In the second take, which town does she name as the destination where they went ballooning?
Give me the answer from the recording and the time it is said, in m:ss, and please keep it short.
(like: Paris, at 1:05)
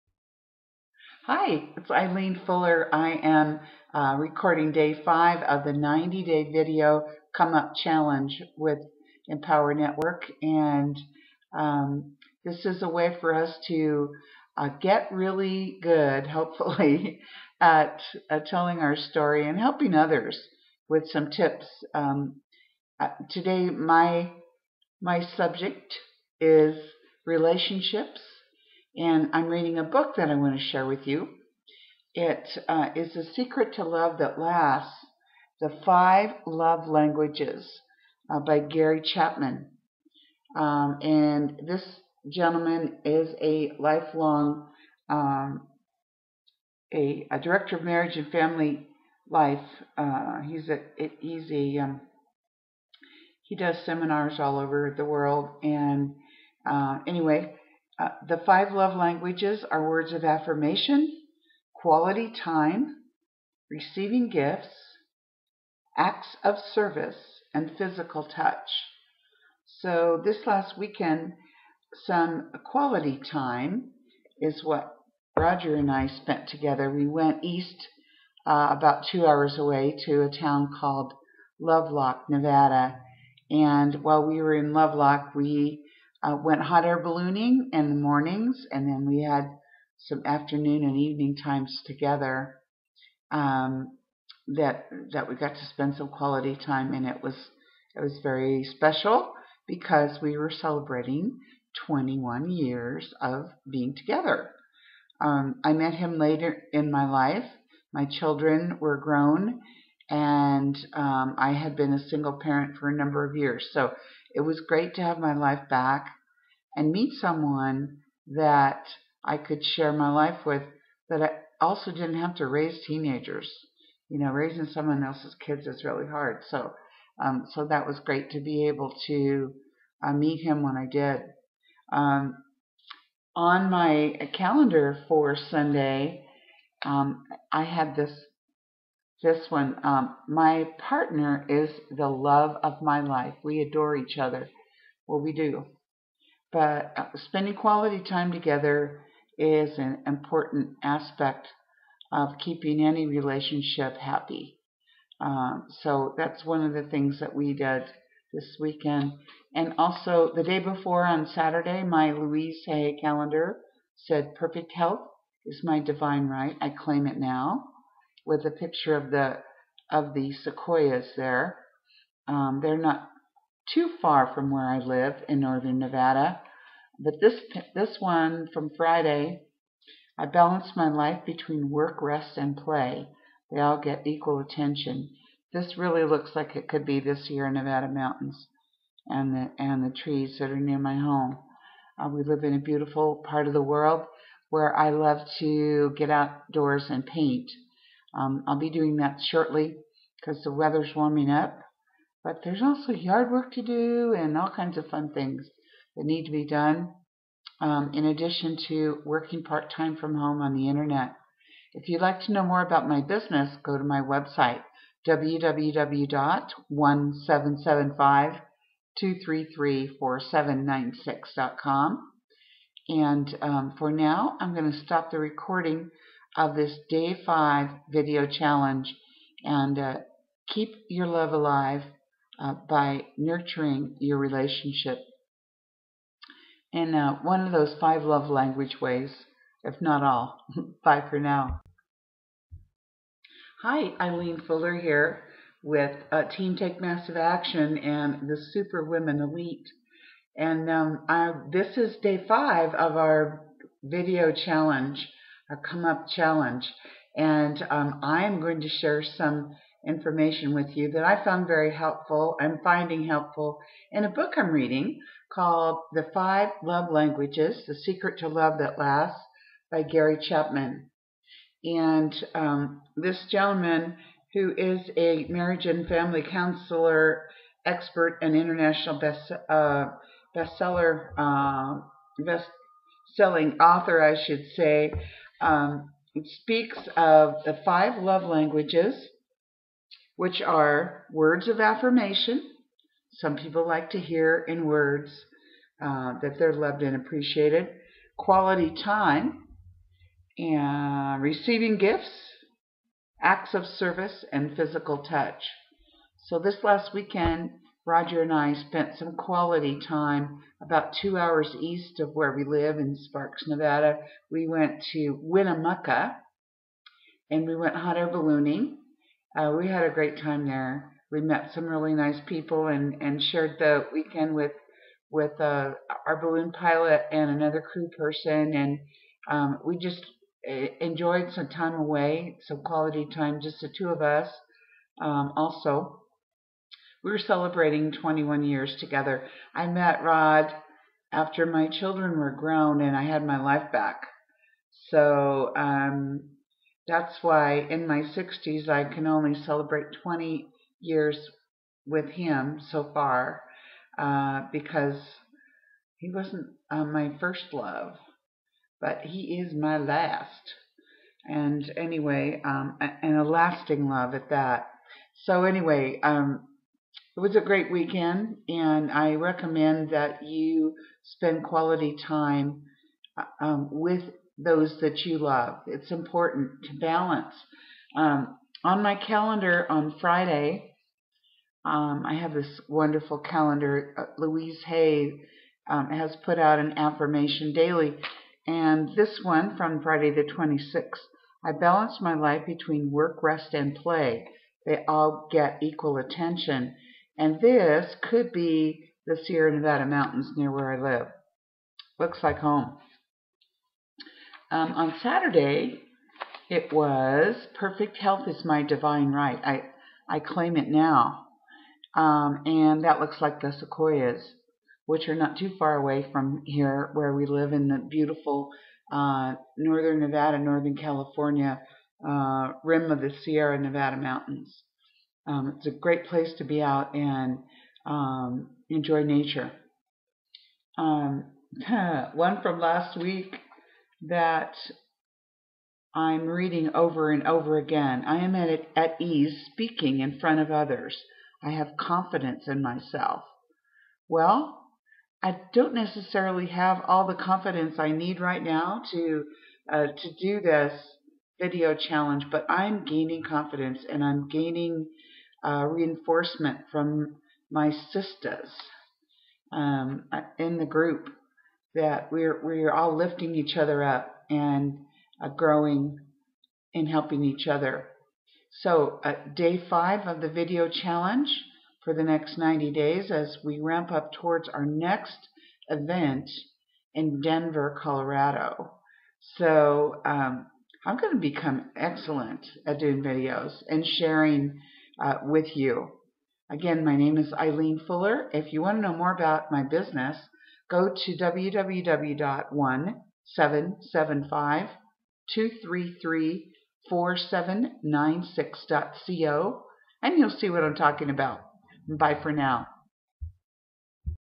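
Winnemucca, at 5:15.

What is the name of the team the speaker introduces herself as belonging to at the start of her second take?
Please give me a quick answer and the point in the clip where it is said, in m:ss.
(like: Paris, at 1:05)
Team Take Massive Action, at 4:06.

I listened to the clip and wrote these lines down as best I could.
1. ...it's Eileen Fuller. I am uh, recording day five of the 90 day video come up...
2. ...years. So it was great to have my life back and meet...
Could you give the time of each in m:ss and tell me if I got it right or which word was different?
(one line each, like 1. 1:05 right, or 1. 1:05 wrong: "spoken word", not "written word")
1. 0:01 right
2. 1:53 right.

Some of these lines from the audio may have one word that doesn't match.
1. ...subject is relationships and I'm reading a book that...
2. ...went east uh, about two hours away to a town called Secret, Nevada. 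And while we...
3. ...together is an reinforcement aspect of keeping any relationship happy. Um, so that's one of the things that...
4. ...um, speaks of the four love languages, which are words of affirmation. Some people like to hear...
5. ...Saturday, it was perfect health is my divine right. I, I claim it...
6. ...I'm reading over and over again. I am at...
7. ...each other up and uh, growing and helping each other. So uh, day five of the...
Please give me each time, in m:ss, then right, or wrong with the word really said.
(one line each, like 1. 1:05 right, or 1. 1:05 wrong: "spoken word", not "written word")
1. 0:25 right
2. 1:17 wrong: "Lovelock", not "Secret"
3. 2:28 wrong: "important", not "reinforcement"
4. 4:45 wrong: "five", not "four"
5. 6:45 right
6. 7:15 right
7. 7:43 right.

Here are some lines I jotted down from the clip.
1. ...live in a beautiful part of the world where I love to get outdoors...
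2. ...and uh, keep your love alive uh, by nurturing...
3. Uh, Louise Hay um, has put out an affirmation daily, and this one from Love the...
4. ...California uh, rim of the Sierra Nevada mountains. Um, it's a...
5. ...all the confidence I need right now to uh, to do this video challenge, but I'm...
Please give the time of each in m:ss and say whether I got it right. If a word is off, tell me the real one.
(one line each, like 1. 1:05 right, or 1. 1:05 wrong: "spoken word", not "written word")
1. 3:12 right
2. 3:49 right
3. 6:23 wrong: "Friday", not "Love"
4. 7:00 right
5. 7:26 right.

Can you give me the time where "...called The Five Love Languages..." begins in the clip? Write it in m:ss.
4:25.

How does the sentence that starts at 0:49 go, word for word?
Uh, he's a, it, he's a, um, he does seminars all over the world.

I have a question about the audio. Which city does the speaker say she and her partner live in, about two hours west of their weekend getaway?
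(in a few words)
Sparks, Nevada.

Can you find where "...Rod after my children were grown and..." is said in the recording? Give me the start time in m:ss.
5:40.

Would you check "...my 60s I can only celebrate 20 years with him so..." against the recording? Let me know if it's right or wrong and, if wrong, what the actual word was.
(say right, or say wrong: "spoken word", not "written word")
right.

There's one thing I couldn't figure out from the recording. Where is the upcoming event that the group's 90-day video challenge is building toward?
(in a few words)
Denver, Colorado.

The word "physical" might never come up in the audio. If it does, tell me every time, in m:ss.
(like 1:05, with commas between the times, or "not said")
1:07, 5:04.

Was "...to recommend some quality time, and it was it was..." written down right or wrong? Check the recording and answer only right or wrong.
wrong.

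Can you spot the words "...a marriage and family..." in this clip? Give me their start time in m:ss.
4:34.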